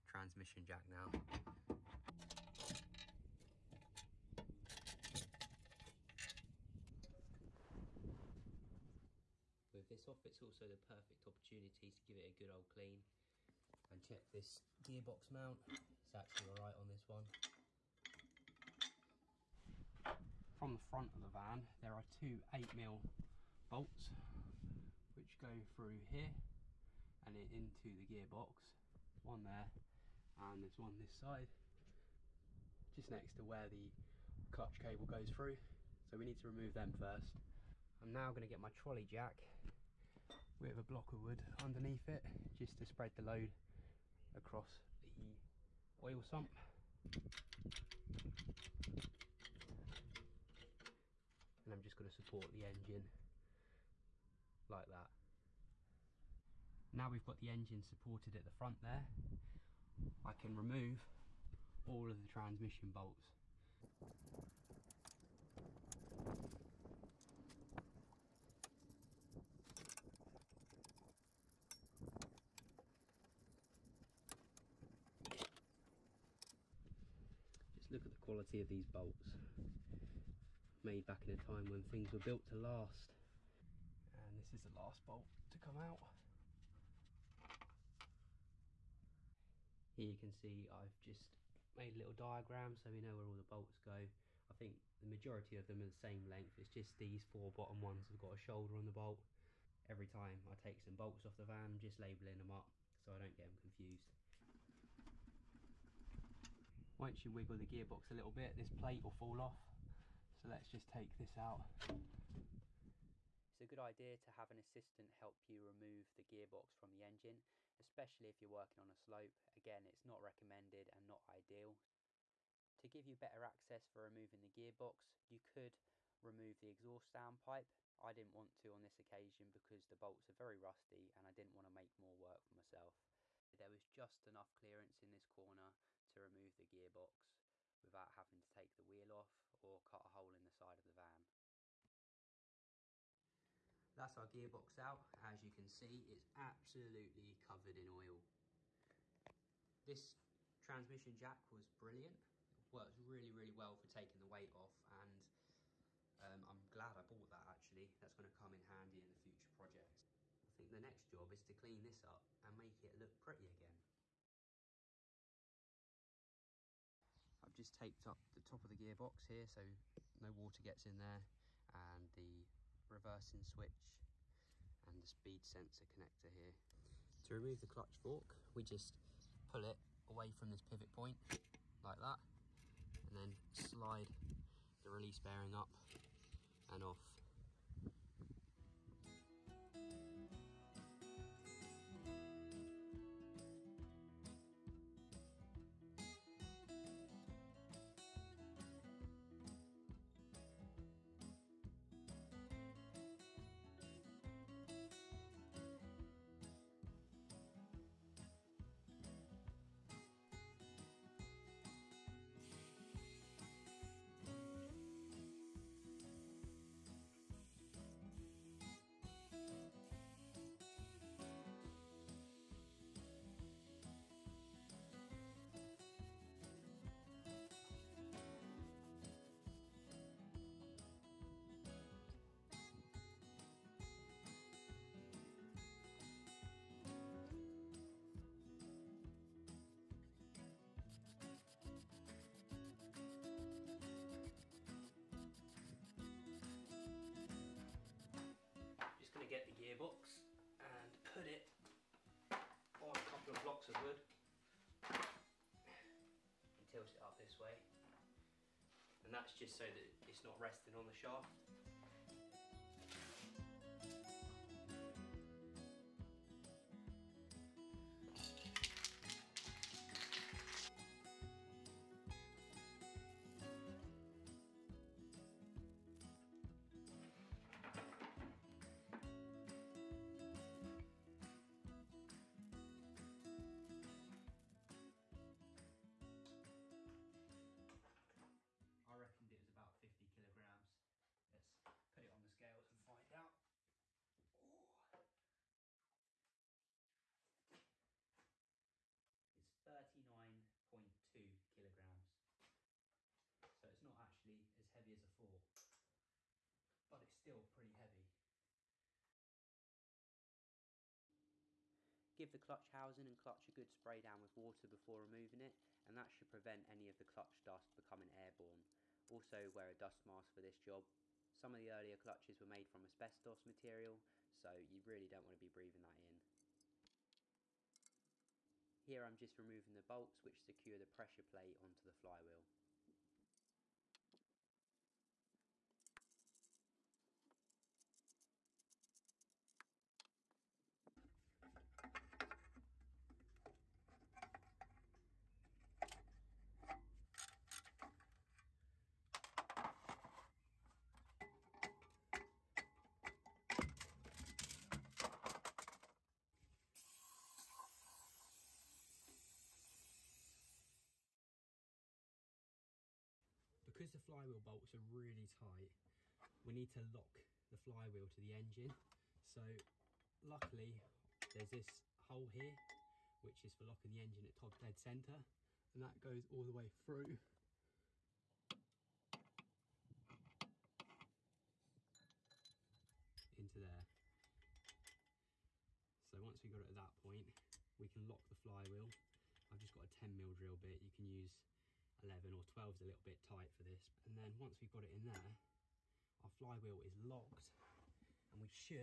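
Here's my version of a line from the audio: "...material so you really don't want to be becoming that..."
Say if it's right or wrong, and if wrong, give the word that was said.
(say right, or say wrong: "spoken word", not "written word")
wrong: "breathing", not "becoming".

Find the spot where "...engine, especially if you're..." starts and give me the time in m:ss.
1:57.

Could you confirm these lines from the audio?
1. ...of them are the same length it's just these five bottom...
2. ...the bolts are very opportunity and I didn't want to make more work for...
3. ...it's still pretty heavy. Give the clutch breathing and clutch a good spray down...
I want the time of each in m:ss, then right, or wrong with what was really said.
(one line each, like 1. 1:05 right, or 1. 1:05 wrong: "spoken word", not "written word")
1. 1:35 wrong: "four", not "five"
2. 2:09 wrong: "rusty", not "opportunity"
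3. 5:07 wrong: "housing", not "breathing".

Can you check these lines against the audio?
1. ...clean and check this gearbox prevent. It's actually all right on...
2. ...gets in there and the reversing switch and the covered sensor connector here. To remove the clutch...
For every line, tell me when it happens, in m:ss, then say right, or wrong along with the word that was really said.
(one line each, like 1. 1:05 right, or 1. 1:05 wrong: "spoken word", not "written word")
1. 0:12 wrong: "mount", not "prevent"
2. 2:50 wrong: "speed", not "covered".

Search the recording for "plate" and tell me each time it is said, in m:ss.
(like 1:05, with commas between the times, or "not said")
1:48, 5:31.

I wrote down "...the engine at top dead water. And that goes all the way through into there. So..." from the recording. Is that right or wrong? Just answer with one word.
wrong.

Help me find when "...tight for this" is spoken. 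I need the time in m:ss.
6:33.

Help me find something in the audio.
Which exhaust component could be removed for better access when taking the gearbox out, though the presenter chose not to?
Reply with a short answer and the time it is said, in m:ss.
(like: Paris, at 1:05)
Exhaust downpipe, at 2:06.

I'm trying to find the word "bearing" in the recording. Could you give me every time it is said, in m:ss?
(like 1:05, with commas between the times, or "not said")
3:05.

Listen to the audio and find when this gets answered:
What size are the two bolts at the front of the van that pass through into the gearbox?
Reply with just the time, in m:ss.
0:22.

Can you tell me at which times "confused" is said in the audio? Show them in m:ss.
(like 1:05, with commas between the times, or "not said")
1:43.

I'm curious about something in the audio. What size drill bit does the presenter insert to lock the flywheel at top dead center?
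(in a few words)
10mm.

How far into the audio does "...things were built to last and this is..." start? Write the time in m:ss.
1:21.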